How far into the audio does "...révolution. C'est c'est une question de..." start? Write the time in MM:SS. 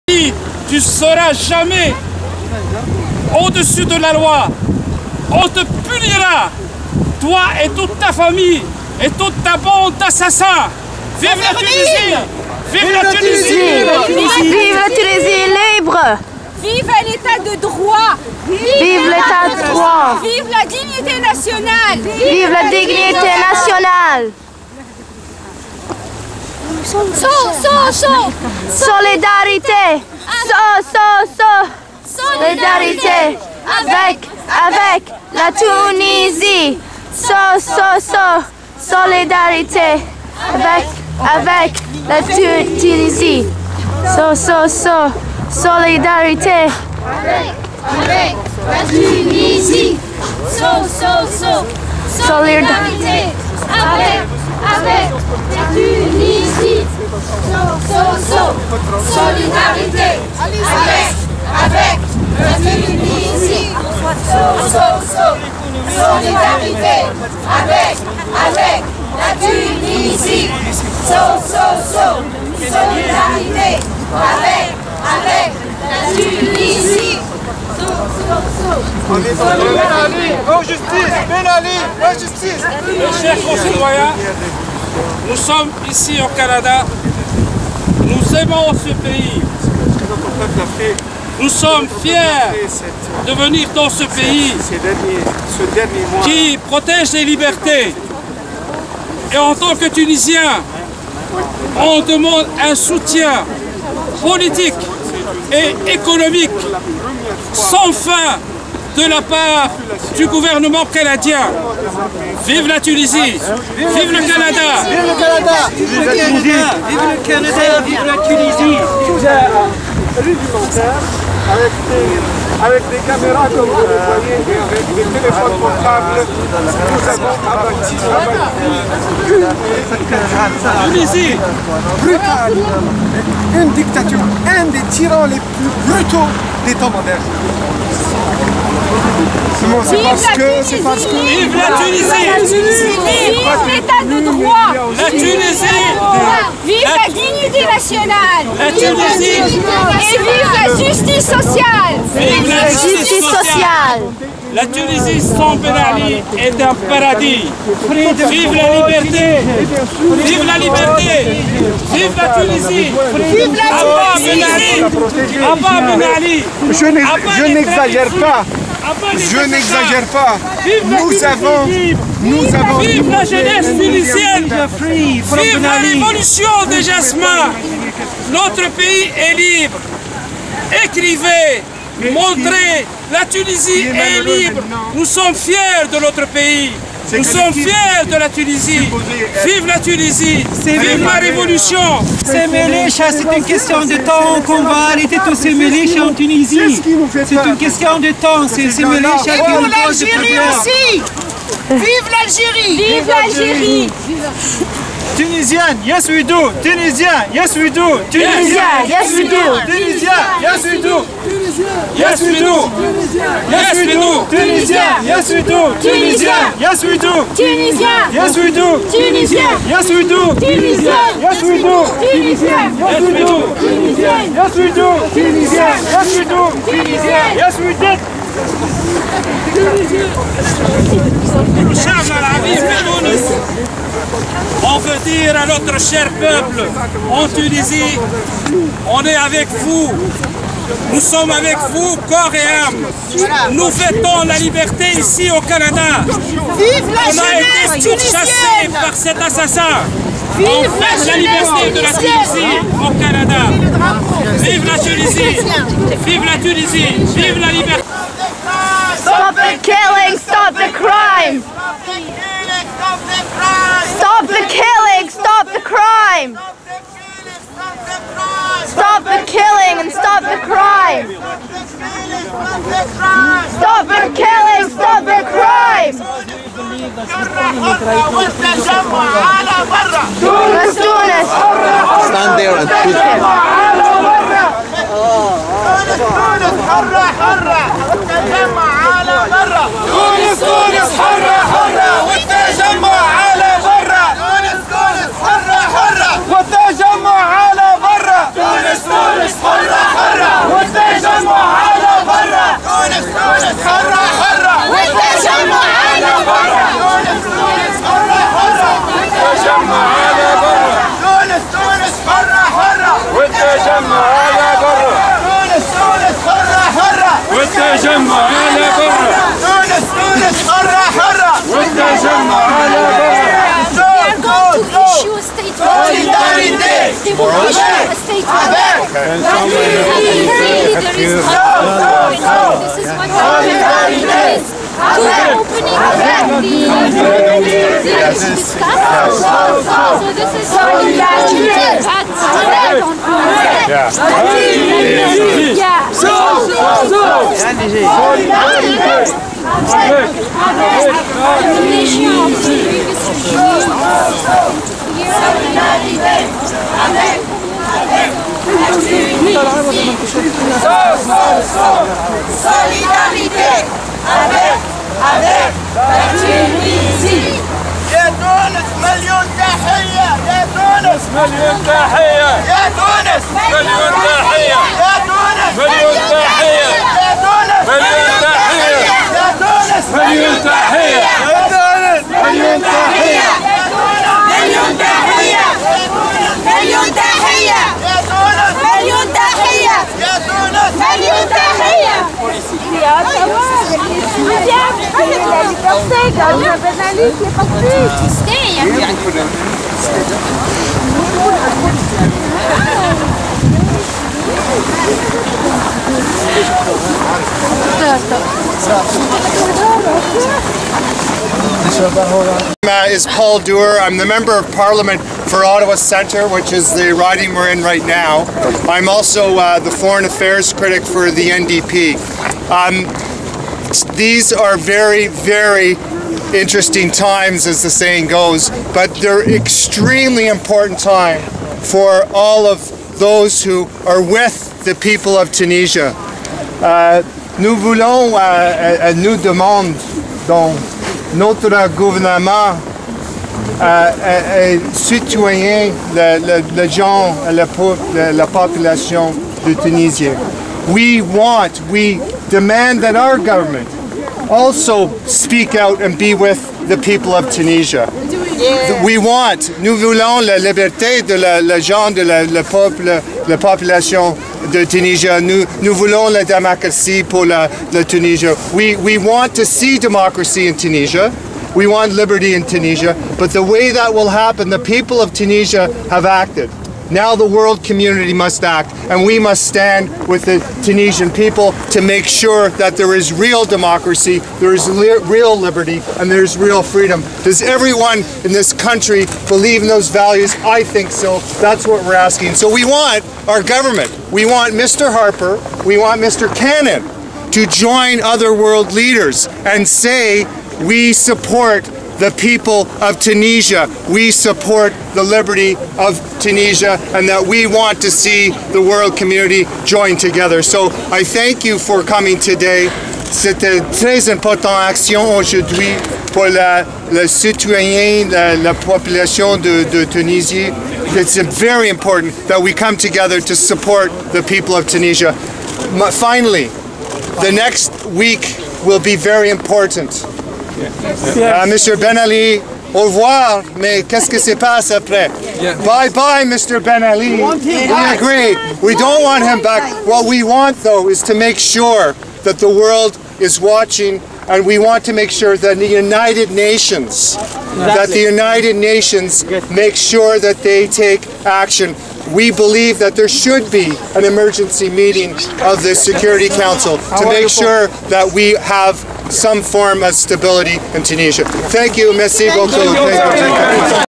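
03:11.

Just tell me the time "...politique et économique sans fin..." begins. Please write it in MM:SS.
01:44.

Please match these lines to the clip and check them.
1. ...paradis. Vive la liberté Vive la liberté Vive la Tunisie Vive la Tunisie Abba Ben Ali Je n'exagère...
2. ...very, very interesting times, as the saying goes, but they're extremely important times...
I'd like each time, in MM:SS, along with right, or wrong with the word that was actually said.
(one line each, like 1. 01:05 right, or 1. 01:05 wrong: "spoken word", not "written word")
1. 02:36 right
2. 07:04 right.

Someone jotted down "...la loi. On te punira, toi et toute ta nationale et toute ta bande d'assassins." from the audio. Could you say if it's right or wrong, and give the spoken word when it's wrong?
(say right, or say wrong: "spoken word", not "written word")
wrong: "famille", not "nationale".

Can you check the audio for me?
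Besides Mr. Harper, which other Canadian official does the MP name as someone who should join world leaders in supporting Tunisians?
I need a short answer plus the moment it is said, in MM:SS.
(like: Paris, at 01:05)
Mr. Cannon, at 08:16.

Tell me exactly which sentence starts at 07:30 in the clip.
We want, we demand that our government also speak out and be with the people of Tunisia.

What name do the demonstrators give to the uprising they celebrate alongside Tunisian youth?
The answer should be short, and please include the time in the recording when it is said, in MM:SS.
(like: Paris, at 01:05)
révolution de Jasmin, at 02:55.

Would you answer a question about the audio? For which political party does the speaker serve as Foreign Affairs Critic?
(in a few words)
NDP.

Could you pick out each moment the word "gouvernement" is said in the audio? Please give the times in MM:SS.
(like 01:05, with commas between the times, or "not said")
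01:50, 07:21.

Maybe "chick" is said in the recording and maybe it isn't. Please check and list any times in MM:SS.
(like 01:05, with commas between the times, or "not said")
not said.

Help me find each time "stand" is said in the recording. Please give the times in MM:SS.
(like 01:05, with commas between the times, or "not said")
04:42, 07:59.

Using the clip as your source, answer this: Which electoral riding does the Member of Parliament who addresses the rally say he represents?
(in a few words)
Ottawa Centre.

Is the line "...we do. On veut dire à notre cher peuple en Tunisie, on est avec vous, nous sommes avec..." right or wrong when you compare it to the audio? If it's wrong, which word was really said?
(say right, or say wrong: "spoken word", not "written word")
right.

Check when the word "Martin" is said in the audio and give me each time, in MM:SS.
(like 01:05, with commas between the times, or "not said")
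not said.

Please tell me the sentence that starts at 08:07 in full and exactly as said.
Does everyone in this country believe in those values?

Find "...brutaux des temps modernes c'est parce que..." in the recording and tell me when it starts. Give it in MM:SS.
02:15.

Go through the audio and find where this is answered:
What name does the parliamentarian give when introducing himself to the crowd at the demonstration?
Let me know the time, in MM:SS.
06:53.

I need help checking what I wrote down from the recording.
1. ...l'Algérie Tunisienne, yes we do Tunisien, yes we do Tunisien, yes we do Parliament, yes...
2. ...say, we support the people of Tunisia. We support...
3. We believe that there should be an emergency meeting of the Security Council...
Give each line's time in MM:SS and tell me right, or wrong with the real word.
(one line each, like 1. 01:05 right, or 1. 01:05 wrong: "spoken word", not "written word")
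1. 03:23 wrong: "Tunisien", not "Parliament"
2. 08:19 right
3. 09:12 right.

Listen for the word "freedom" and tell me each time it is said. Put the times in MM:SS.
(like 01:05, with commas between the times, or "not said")
08:06.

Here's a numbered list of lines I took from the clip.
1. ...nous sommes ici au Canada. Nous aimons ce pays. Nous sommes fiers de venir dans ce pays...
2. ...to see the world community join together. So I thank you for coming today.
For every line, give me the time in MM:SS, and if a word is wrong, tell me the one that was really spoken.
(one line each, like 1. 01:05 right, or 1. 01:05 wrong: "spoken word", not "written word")
1. 01:25 right
2. 08:27 right.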